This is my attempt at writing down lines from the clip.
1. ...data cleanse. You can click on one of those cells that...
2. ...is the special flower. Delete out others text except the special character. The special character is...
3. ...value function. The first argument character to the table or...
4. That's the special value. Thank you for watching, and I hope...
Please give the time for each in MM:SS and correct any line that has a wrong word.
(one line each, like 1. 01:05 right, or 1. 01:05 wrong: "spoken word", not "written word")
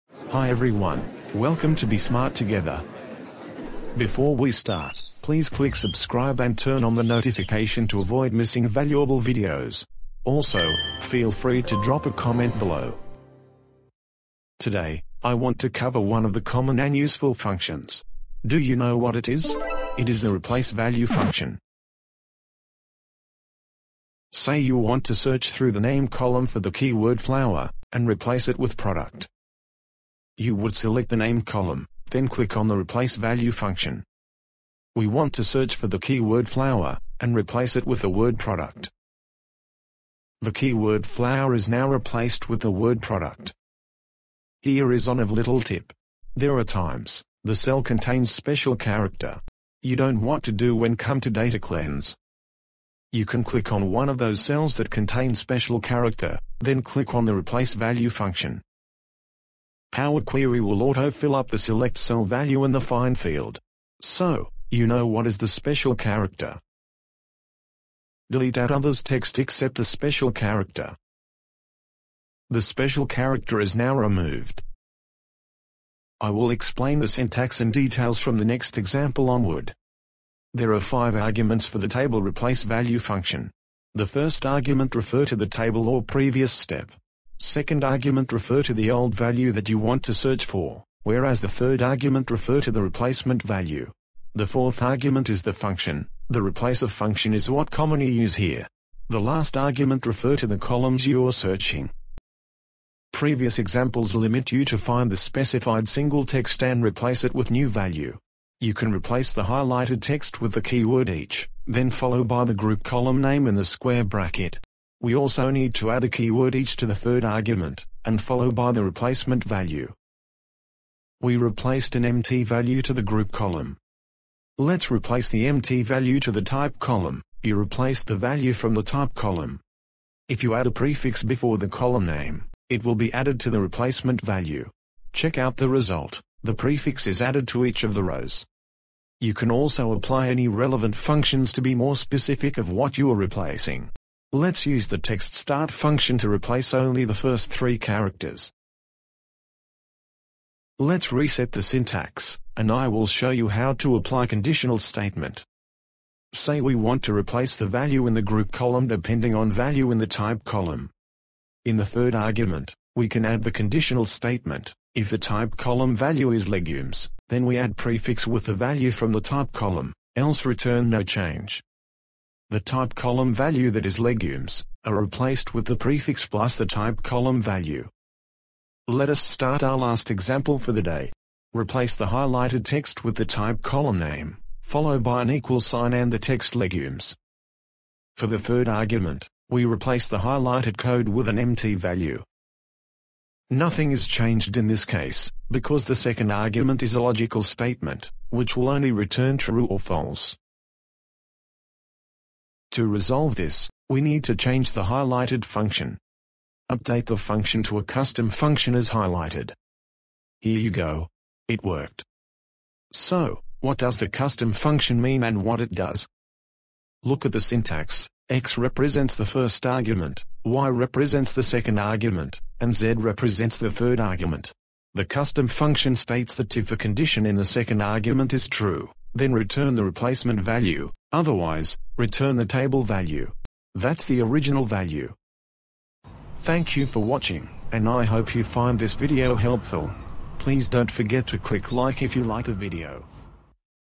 1. 00:51 right
2. 01:05 wrong: "character", not "flower"
3. 01:22 wrong: "refer", not "character"
4. 03:53 wrong: "original", not "special".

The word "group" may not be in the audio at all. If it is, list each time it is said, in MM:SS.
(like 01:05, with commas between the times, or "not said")
01:52, 02:03, 02:38.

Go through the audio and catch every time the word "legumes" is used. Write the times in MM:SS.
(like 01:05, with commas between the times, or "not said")
02:46, 02:53, 03:06.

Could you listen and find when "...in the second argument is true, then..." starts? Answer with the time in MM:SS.
03:47.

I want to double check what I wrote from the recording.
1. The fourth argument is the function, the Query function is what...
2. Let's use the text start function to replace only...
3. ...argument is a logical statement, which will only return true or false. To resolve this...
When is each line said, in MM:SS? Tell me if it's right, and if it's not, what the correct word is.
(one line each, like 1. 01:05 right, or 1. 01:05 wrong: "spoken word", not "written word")
1. 01:34 wrong: "Replacer", not "Query"
2. 02:24 right
3. 03:16 right.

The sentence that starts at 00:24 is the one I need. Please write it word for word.
Say you want to search through the name column for the keyword flower, and replace it with product.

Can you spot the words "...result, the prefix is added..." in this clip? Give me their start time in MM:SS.
02:15.